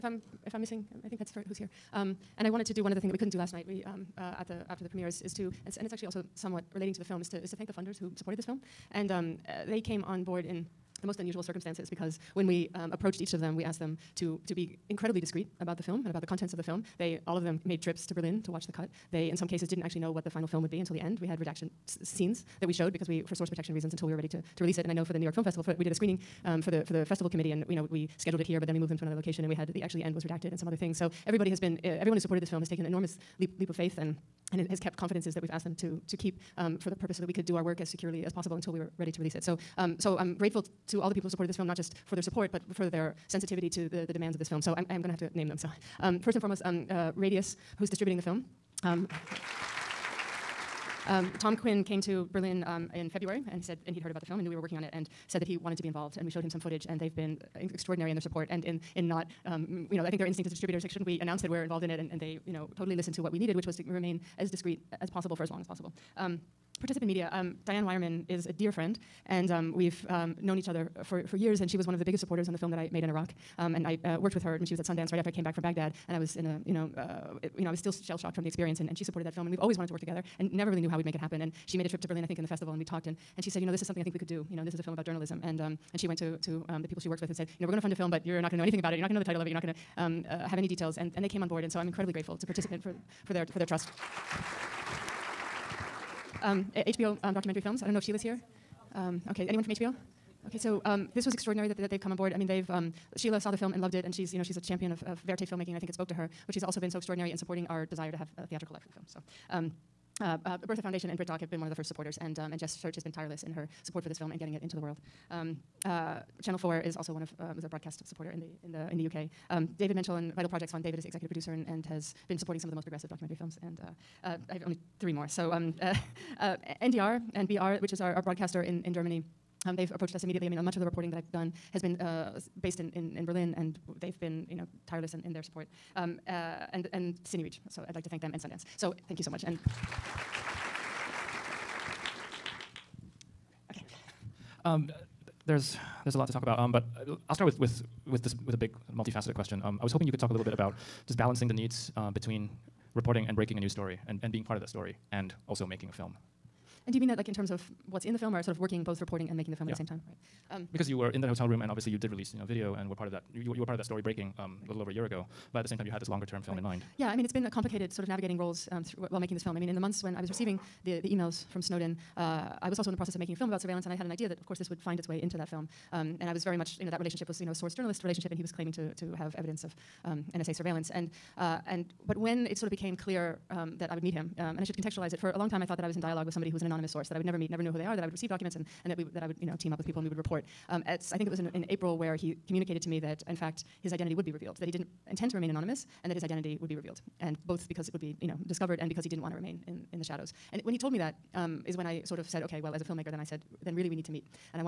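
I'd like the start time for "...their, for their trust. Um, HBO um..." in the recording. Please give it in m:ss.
1:33.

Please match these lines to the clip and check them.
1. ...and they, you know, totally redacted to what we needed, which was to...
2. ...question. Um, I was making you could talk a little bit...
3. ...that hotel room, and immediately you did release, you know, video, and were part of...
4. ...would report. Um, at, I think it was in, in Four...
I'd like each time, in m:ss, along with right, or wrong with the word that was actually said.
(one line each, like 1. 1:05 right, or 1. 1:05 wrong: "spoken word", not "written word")
1. 1:02 wrong: "listened", not "redacted"
2. 2:29 wrong: "hoping", not "making"
3. 2:41 wrong: "obviously", not "immediately"
4. 3:10 wrong: "April", not "Four".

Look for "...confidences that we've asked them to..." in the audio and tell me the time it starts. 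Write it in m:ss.
0:34.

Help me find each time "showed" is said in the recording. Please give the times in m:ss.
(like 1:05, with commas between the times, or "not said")
0:22, 0:56.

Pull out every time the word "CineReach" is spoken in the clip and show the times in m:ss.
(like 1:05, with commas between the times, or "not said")
2:17.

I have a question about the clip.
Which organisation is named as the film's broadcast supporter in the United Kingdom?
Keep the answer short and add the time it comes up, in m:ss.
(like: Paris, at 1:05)
Channel Four, at 1:56.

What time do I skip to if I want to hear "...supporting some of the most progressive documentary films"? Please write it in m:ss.
2:02.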